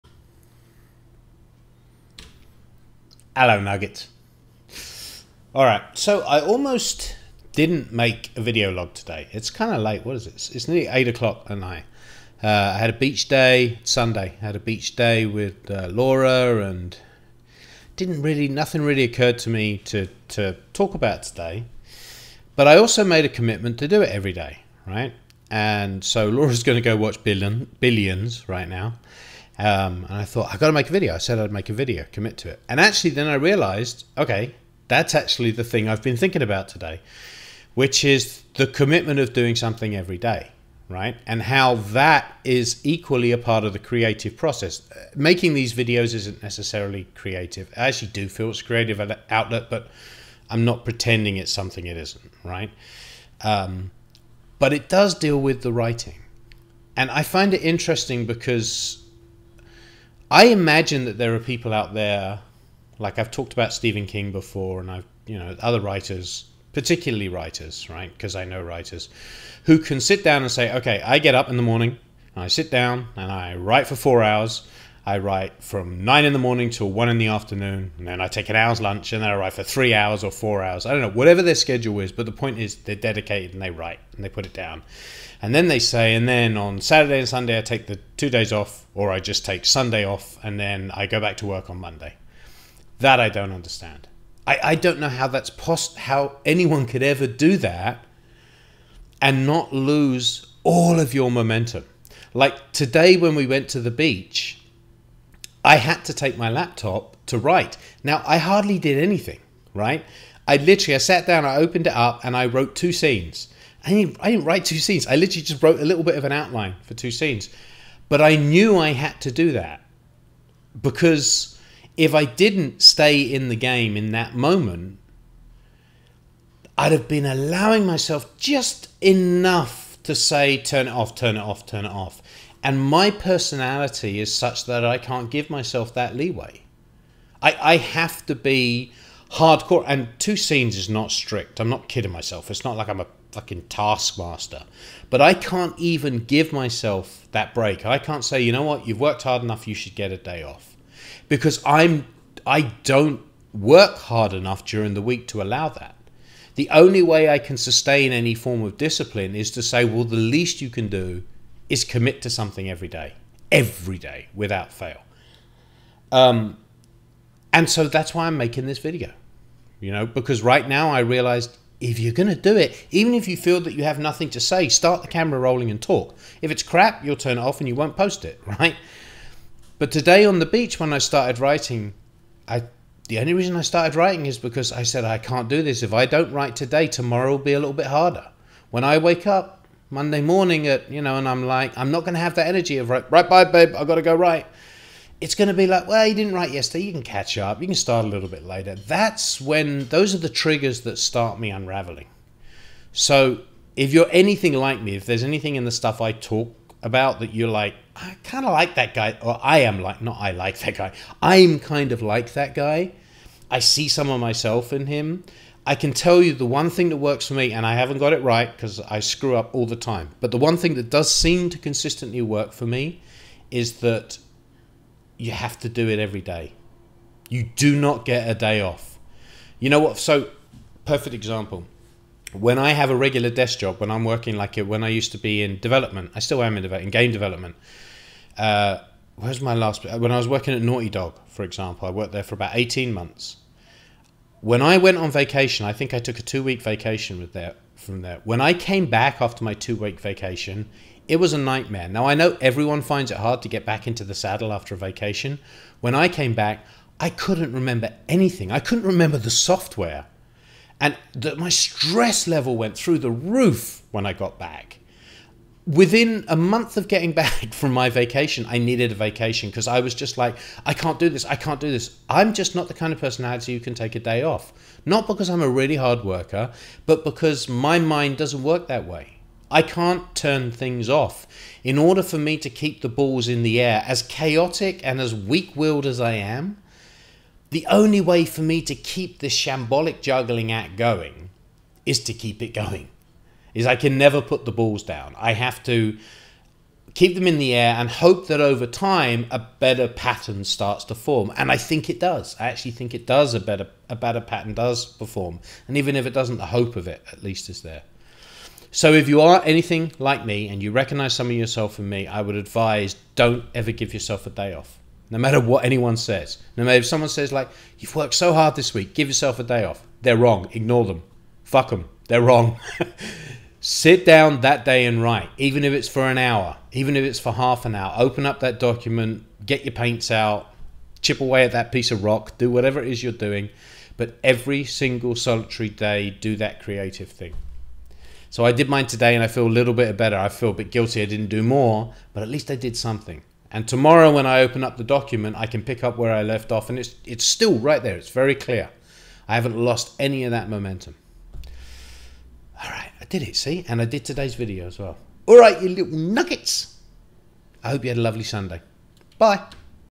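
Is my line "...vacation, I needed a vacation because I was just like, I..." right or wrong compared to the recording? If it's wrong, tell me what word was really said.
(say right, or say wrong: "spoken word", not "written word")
right.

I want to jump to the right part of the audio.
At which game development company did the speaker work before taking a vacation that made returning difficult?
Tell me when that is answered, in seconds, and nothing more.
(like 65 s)
240 s.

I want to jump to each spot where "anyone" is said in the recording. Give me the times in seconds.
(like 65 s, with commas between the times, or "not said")
96 s, 315 s.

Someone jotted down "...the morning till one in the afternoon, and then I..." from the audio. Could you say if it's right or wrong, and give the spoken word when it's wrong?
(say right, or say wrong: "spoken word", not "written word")
right.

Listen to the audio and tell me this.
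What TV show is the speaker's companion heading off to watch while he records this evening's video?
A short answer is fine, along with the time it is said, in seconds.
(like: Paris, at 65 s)
Billions, at 27 s.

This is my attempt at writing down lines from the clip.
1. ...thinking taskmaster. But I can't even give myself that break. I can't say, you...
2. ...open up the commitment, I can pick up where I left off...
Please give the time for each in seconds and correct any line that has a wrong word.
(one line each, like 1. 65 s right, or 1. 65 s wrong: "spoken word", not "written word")
1. 143 s wrong: "fucking", not "thinking"
2. 344 s wrong: "document", not "commitment".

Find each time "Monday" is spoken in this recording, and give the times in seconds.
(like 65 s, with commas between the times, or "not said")
91 s, 189 s.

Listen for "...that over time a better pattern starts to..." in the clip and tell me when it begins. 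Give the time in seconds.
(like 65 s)
298 s.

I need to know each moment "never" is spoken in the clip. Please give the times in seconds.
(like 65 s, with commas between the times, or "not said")
293 s.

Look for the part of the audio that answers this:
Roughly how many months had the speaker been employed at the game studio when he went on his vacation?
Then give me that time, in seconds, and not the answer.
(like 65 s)
242 s.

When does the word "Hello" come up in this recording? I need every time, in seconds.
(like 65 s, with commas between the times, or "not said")
3 s.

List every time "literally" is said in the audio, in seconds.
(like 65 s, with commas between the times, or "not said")
110 s, 115 s.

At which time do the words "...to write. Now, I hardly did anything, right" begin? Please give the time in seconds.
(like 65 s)
107 s.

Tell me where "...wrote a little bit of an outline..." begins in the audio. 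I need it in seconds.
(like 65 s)
115 s.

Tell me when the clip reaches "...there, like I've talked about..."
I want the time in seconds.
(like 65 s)
61 s.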